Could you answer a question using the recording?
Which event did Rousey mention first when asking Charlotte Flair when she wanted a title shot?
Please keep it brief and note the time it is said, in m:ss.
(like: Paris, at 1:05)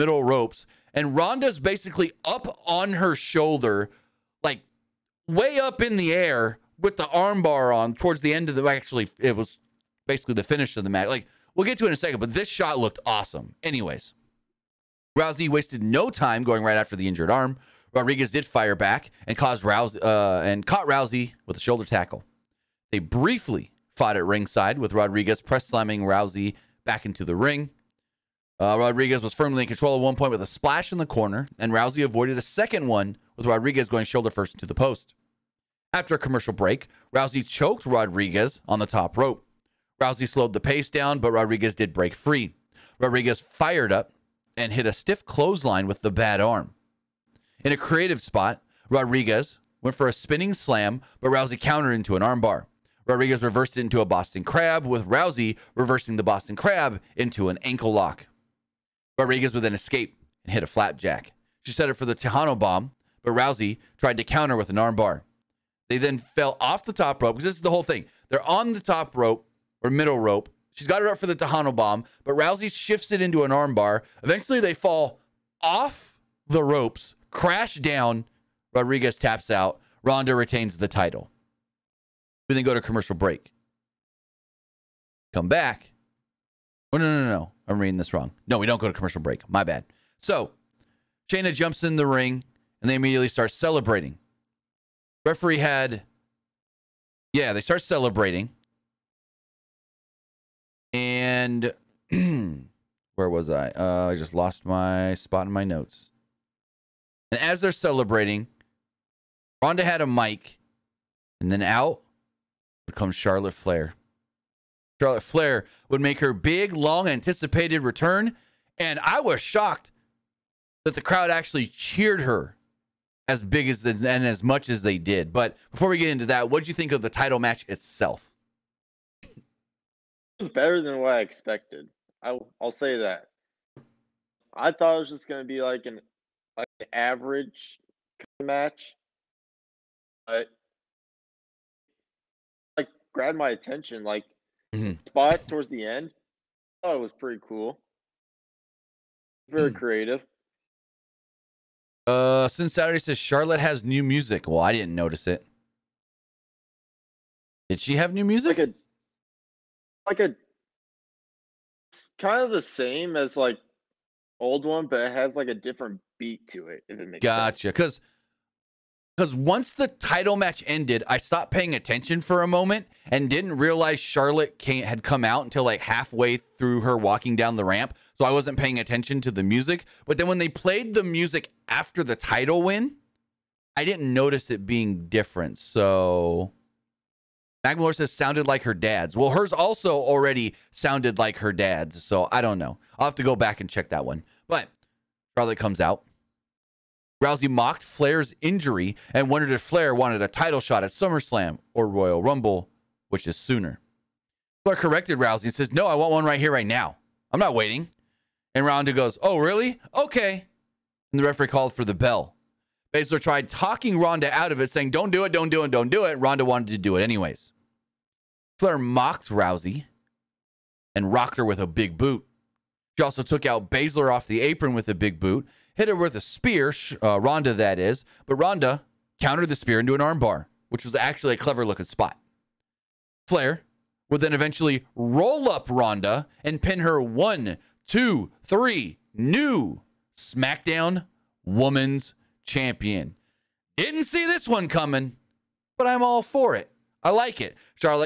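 SummerSlam, at 3:20.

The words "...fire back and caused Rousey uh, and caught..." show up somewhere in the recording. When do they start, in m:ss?
0:18.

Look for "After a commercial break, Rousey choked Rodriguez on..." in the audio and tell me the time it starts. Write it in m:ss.
0:35.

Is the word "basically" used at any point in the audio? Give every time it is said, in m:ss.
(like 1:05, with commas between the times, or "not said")
0:01, 0:10.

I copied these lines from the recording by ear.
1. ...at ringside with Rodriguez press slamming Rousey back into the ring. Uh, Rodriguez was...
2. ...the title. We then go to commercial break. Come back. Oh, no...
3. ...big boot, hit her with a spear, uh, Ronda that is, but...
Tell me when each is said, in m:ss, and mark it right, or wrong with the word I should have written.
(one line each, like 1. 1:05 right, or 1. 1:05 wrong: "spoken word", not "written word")
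1. 0:24 right
2. 1:20 right
3. 3:44 right.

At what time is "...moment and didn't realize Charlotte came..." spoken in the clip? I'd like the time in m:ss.
2:52.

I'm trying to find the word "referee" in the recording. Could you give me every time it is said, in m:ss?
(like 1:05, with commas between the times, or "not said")
1:35, 3:31.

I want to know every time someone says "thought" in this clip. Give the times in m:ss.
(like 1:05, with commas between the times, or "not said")
2:14, 2:26.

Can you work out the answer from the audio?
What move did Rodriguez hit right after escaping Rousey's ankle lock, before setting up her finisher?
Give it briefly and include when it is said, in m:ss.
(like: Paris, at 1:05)
Flapjack, at 1:00.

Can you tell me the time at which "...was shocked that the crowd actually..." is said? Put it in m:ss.
1:59.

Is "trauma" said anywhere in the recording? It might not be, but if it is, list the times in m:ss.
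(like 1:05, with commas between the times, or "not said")
not said.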